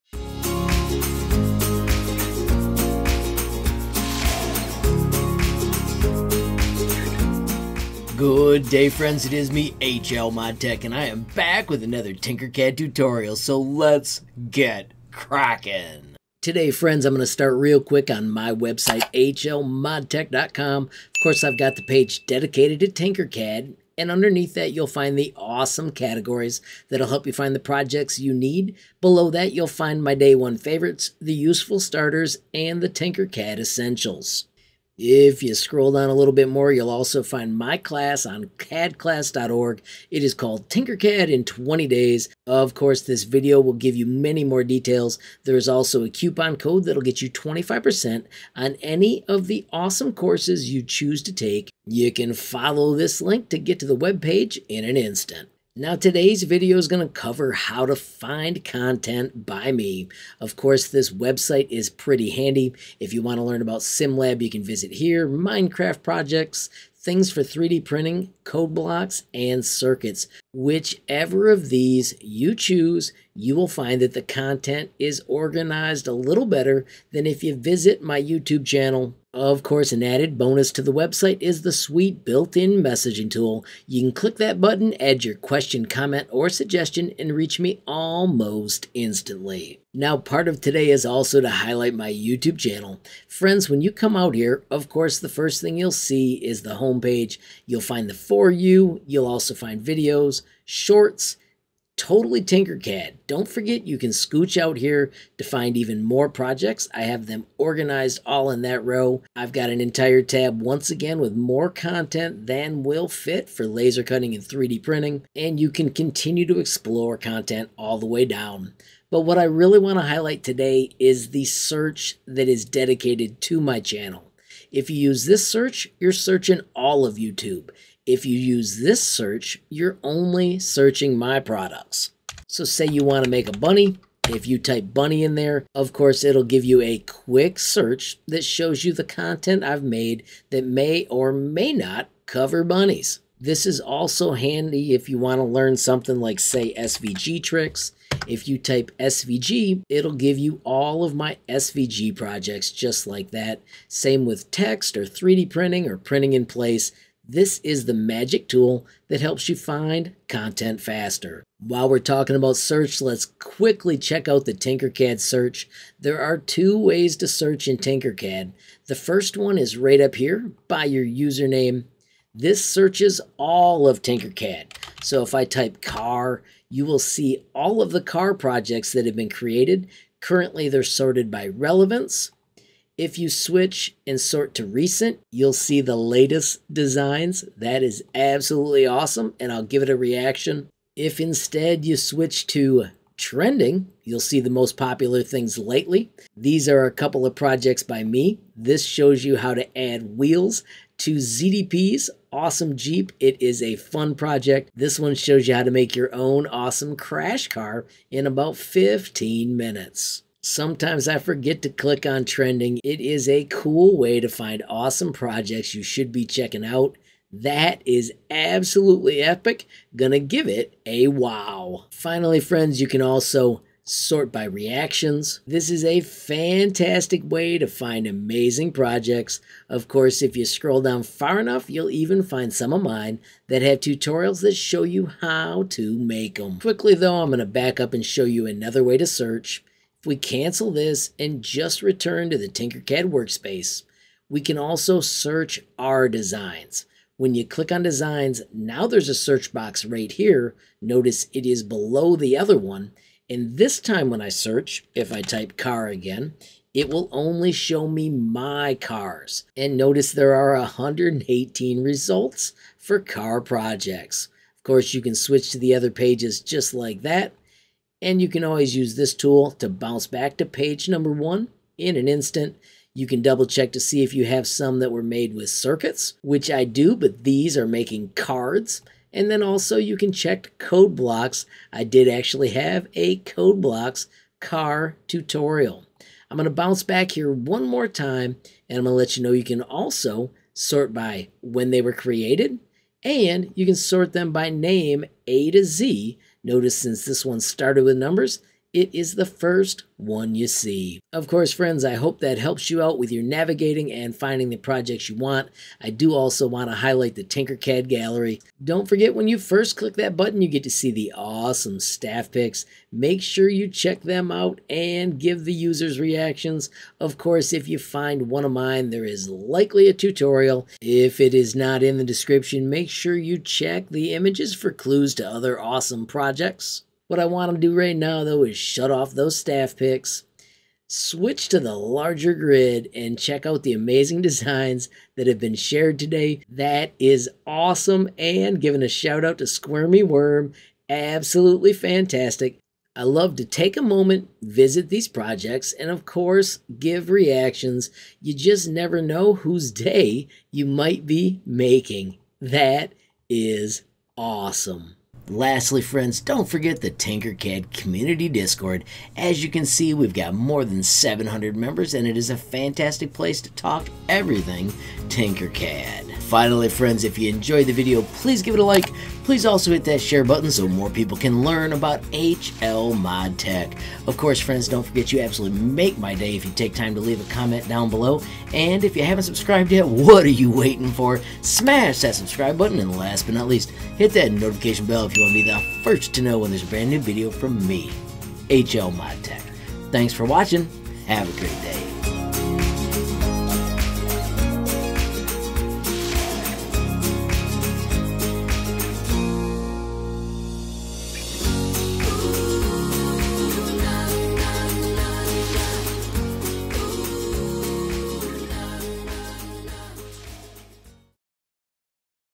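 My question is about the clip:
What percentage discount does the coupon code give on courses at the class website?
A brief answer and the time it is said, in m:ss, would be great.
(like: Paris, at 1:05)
25%, at 0:47.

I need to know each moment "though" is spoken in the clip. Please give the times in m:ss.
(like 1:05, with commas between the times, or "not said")
3:56, 5:28.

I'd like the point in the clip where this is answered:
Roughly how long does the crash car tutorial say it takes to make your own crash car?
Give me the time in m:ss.
3:28.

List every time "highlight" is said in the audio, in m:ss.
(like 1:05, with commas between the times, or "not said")
1:31, 2:00, 5:06.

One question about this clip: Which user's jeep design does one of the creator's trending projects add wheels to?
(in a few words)
ZDP.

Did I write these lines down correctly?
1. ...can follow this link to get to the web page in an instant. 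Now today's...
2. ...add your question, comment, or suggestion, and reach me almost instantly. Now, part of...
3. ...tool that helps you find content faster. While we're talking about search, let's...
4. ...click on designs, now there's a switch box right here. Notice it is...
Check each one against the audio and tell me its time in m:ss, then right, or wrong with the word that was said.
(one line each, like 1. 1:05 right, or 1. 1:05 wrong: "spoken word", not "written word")
1. 0:52 right
2. 1:24 right
3. 2:38 right
4. 4:07 wrong: "search", not "switch".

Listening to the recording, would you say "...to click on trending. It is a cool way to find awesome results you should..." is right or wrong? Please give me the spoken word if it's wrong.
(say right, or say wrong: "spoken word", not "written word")
wrong: "projects", not "results".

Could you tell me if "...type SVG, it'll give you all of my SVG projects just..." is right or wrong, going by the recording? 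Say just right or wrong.
right.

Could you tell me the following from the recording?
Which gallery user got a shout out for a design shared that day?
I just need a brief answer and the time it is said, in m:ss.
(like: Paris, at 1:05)
Squirmy Worm, at 5:39.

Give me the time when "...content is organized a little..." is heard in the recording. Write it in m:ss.
1:14.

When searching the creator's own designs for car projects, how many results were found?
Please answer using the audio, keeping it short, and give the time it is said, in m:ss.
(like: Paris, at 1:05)
118, at 4:20.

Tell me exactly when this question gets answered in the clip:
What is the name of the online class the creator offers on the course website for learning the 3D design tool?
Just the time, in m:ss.
0:40.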